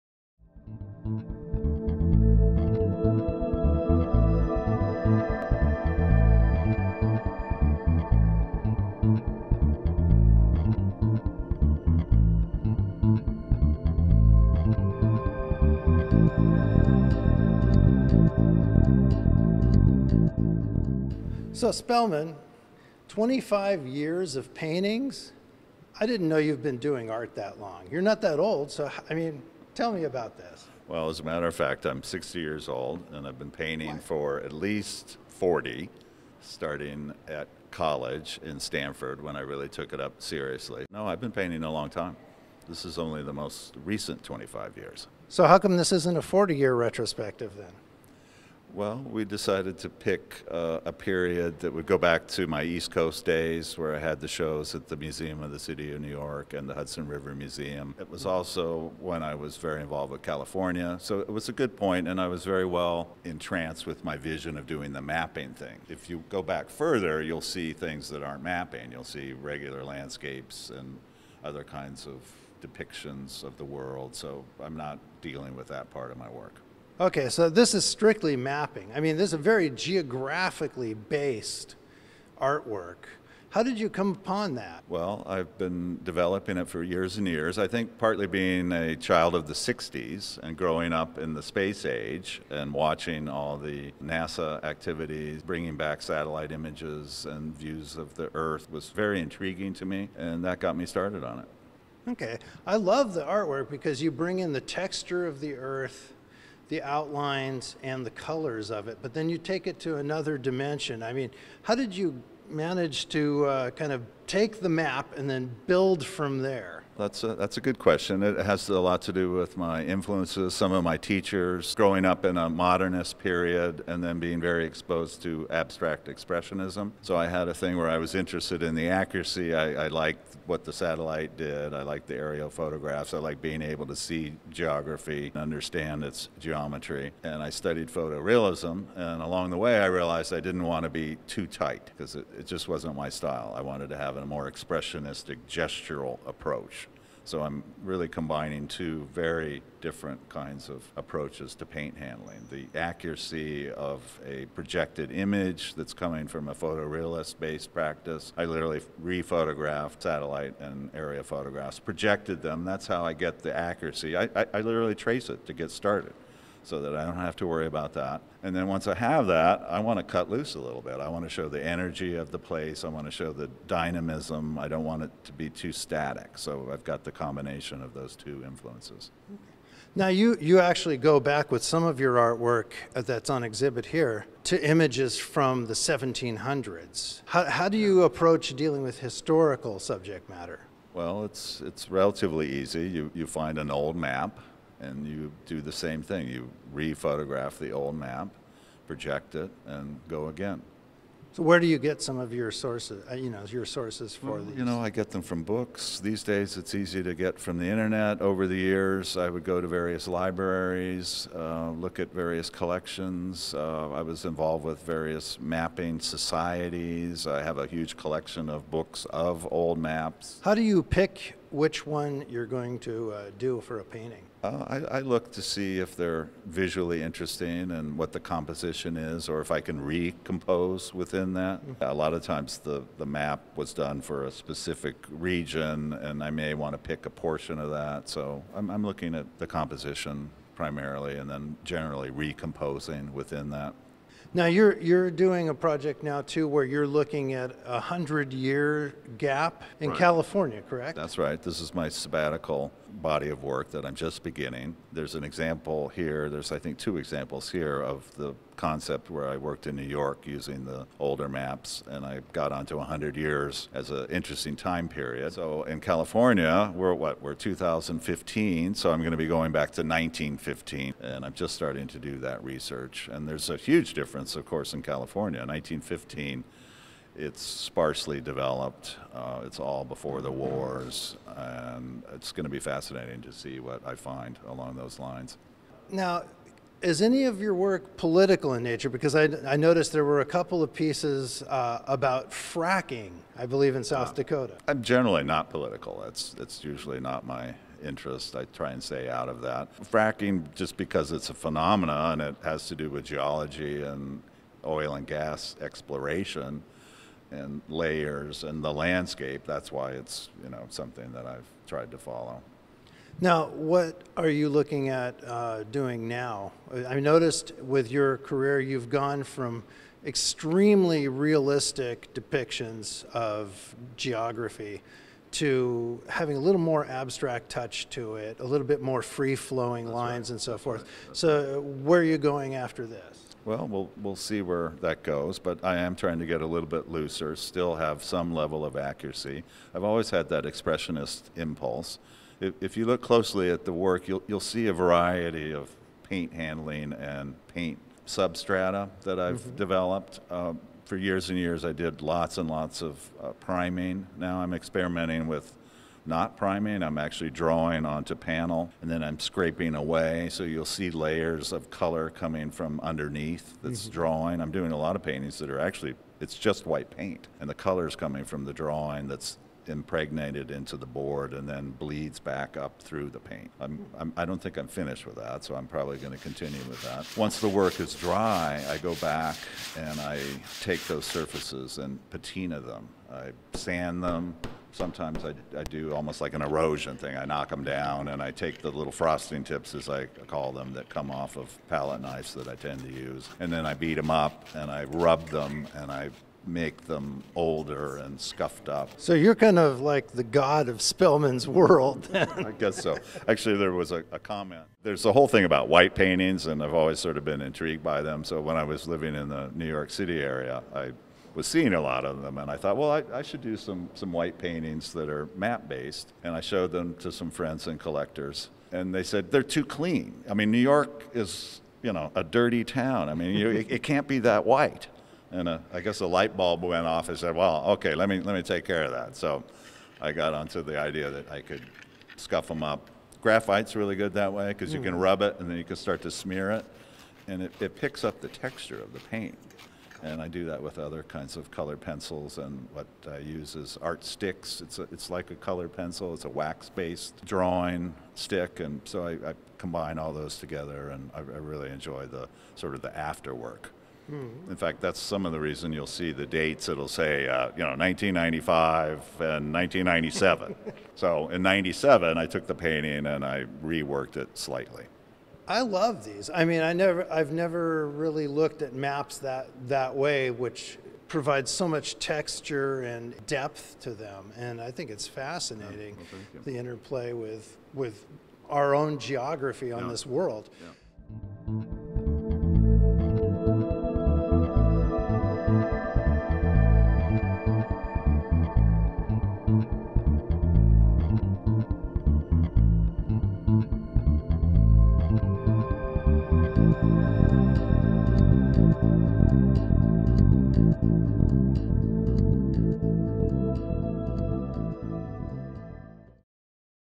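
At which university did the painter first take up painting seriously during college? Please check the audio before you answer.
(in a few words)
Stanford.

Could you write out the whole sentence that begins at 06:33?
And then I beat them up and I rub them and I make them older and scuffed up.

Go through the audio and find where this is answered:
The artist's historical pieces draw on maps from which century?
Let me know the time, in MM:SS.
03:05.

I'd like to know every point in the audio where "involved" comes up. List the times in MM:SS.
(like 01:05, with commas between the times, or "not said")
00:59, 03:34.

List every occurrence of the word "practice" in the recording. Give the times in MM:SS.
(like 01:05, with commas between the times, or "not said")
02:37.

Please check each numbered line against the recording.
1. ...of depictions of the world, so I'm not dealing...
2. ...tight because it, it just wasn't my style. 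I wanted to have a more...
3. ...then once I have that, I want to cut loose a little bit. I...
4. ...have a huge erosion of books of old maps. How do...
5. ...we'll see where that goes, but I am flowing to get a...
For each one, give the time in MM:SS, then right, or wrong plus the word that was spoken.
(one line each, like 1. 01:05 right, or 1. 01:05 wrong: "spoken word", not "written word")
1. 01:12 right
2. 02:21 right
3. 02:48 right
4. 03:37 wrong: "collection", not "erosion"
5. 05:33 wrong: "trying", not "flowing".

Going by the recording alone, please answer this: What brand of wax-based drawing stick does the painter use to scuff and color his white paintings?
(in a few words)
Art Stix.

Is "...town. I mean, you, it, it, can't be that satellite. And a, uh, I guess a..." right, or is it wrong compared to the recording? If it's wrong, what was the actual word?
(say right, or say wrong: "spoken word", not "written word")
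wrong: "white", not "satellite".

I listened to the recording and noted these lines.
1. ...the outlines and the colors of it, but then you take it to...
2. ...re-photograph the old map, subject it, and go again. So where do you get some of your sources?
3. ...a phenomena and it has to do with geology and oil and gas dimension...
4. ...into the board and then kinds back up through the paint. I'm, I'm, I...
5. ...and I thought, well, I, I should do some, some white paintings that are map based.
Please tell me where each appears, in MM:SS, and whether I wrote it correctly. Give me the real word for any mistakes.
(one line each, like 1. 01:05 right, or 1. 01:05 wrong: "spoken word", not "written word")
1. 01:46 right
2. 03:16 wrong: "project", not "subject"
3. 05:01 wrong: "exploration", not "dimension"
4. 06:10 wrong: "bleeds", not "kinds"
5. 06:52 right.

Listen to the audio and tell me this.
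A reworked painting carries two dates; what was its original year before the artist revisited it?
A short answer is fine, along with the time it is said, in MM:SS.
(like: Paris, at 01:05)
1995, at 07:37.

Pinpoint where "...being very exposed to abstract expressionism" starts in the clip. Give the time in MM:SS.
02:04.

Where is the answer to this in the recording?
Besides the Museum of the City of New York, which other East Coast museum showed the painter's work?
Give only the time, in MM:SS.
00:56.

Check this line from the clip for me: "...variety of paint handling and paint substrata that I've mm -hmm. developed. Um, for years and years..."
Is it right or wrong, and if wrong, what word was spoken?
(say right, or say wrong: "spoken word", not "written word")
right.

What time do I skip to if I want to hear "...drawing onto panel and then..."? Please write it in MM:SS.
05:57.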